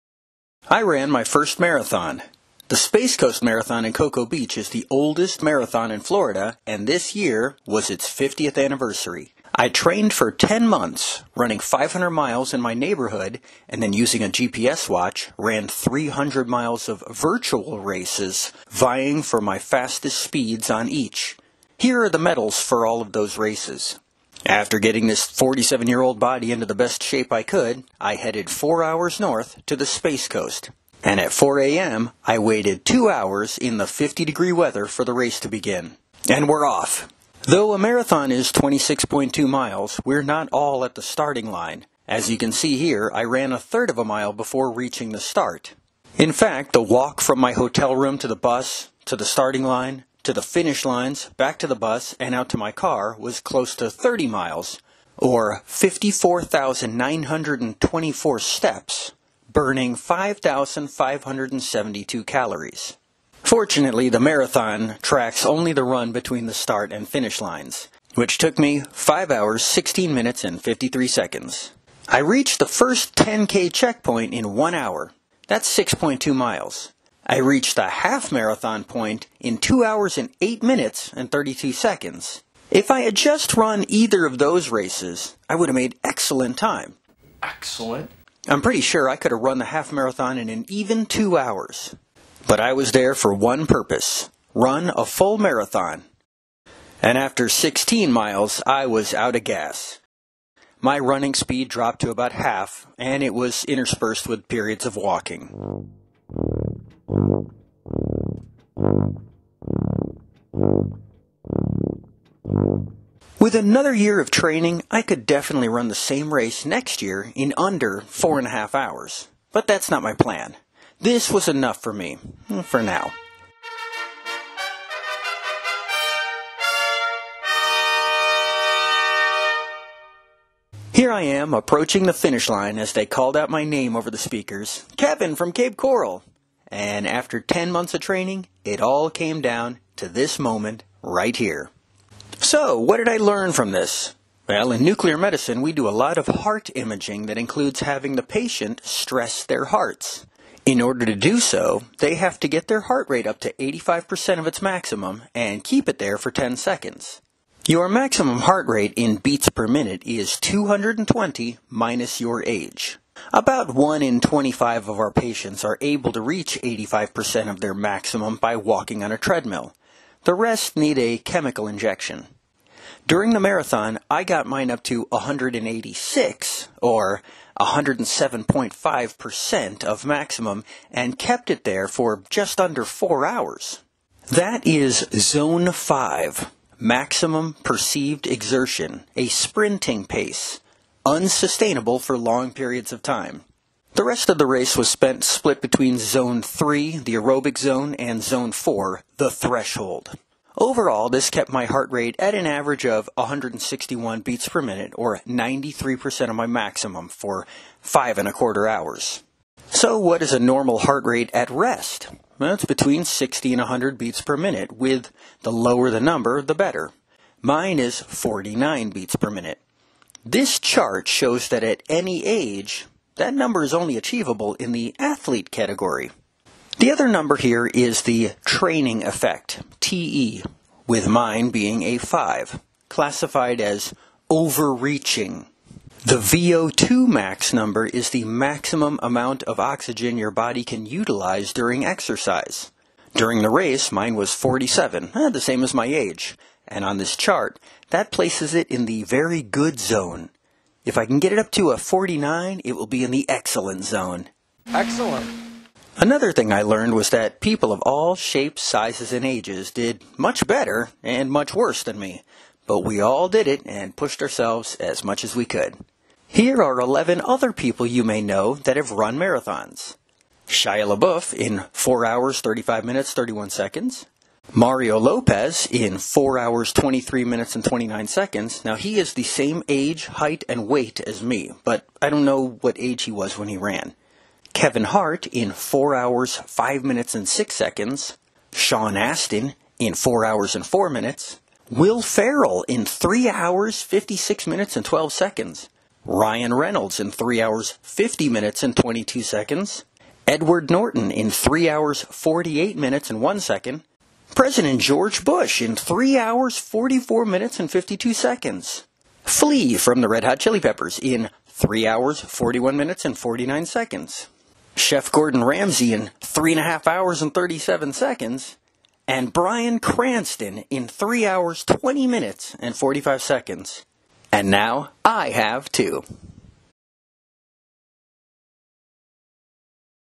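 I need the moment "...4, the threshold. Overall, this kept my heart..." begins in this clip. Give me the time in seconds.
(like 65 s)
198 s.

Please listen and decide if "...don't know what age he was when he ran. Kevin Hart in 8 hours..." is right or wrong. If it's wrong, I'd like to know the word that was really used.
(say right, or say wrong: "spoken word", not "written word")
wrong: "4", not "8".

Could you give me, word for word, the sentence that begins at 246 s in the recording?
And on this chart, that places it in the very good zone.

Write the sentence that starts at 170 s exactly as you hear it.
The rest need a chemical injection.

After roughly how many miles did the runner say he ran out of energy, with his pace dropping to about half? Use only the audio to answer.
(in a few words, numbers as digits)
16.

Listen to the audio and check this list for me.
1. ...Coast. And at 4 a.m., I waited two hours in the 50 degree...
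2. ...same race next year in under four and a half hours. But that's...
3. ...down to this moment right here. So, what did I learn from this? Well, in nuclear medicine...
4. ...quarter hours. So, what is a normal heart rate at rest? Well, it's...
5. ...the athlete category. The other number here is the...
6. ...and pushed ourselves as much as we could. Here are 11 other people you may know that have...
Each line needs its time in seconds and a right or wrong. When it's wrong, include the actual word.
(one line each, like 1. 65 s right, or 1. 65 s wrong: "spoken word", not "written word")
1. 30 s right
2. 115 s right
3. 139 s right
4. 208 s right
5. 224 s right
6. 263 s right.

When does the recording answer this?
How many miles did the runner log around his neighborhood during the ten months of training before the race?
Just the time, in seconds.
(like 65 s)
11 s.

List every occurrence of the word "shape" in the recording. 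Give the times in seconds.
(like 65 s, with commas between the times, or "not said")
27 s, 258 s.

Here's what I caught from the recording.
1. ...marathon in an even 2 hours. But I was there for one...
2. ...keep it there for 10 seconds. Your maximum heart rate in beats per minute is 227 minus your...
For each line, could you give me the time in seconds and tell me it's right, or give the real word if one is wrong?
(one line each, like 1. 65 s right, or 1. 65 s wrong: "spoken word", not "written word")
1. 89 s right
2. 155 s wrong: "220", not "227".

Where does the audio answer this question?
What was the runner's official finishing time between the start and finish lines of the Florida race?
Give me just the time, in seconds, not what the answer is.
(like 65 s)
68 s.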